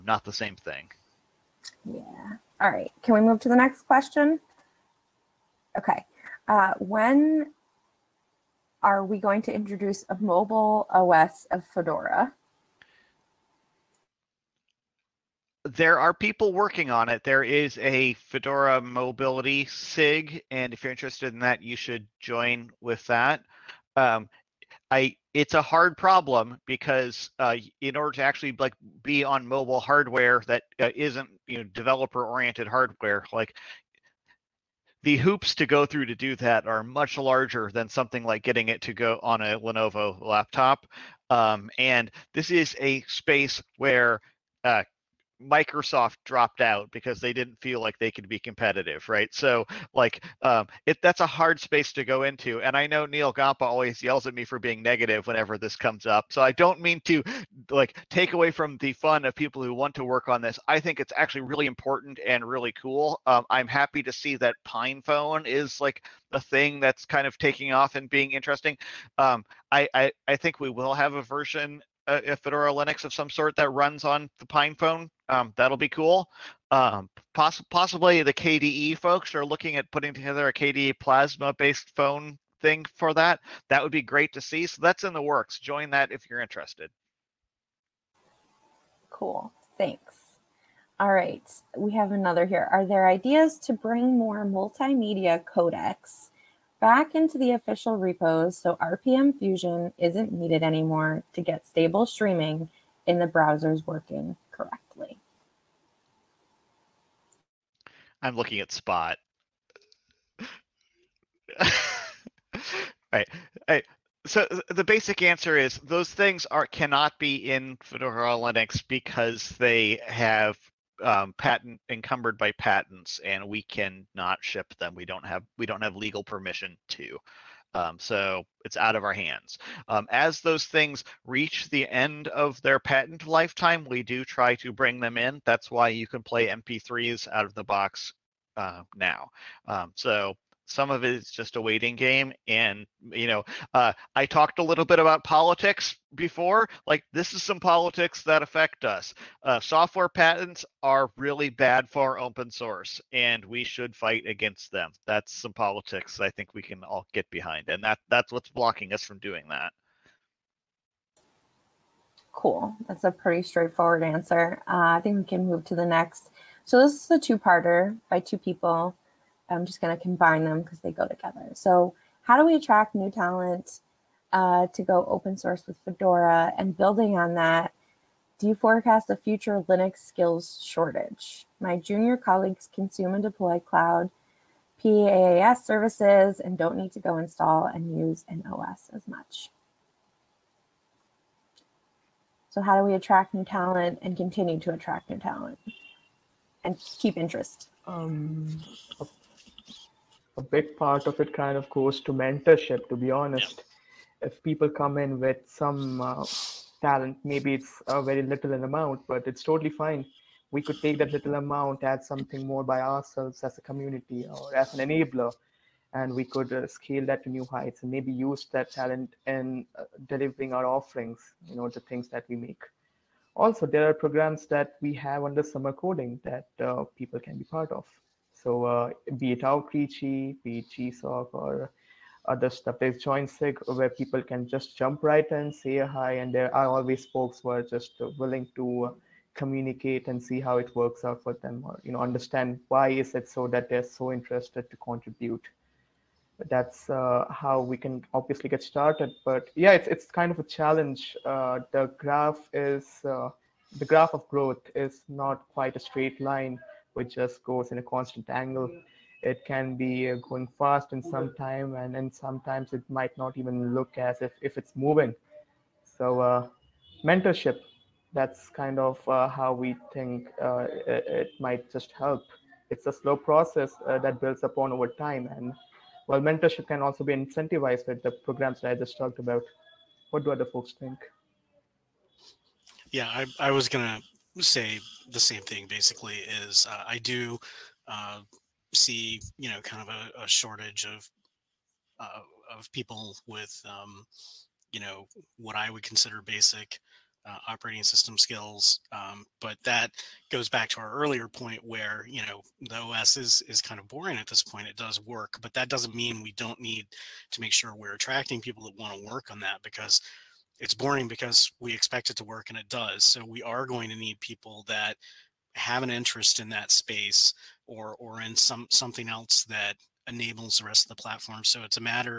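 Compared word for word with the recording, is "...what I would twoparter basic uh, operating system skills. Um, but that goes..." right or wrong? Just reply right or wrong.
wrong.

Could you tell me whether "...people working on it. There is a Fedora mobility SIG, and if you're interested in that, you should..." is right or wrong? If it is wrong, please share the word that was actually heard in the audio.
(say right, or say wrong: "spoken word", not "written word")
right.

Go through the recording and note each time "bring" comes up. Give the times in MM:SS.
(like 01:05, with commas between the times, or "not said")
01:33, 02:14.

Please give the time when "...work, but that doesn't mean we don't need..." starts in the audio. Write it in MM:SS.
05:05.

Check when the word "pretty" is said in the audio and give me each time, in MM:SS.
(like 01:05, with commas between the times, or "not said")
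02:43.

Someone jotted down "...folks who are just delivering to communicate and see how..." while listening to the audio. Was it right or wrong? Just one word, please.
wrong.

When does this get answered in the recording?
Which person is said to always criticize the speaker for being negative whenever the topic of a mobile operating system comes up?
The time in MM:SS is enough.
00:53.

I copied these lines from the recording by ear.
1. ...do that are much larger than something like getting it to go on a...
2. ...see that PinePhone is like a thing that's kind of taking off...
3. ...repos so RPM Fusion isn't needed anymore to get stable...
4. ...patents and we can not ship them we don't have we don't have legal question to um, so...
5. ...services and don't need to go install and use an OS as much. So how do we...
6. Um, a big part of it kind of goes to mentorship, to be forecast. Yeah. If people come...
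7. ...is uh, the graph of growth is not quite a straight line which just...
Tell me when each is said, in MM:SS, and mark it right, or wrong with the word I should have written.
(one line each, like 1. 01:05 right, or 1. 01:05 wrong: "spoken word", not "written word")
1. 00:36 right
2. 01:04 right
3. 01:37 right
4. 02:02 wrong: "permission", not "question"
5. 03:05 right
6. 03:17 wrong: "honest", not "forecast"
7. 04:12 right.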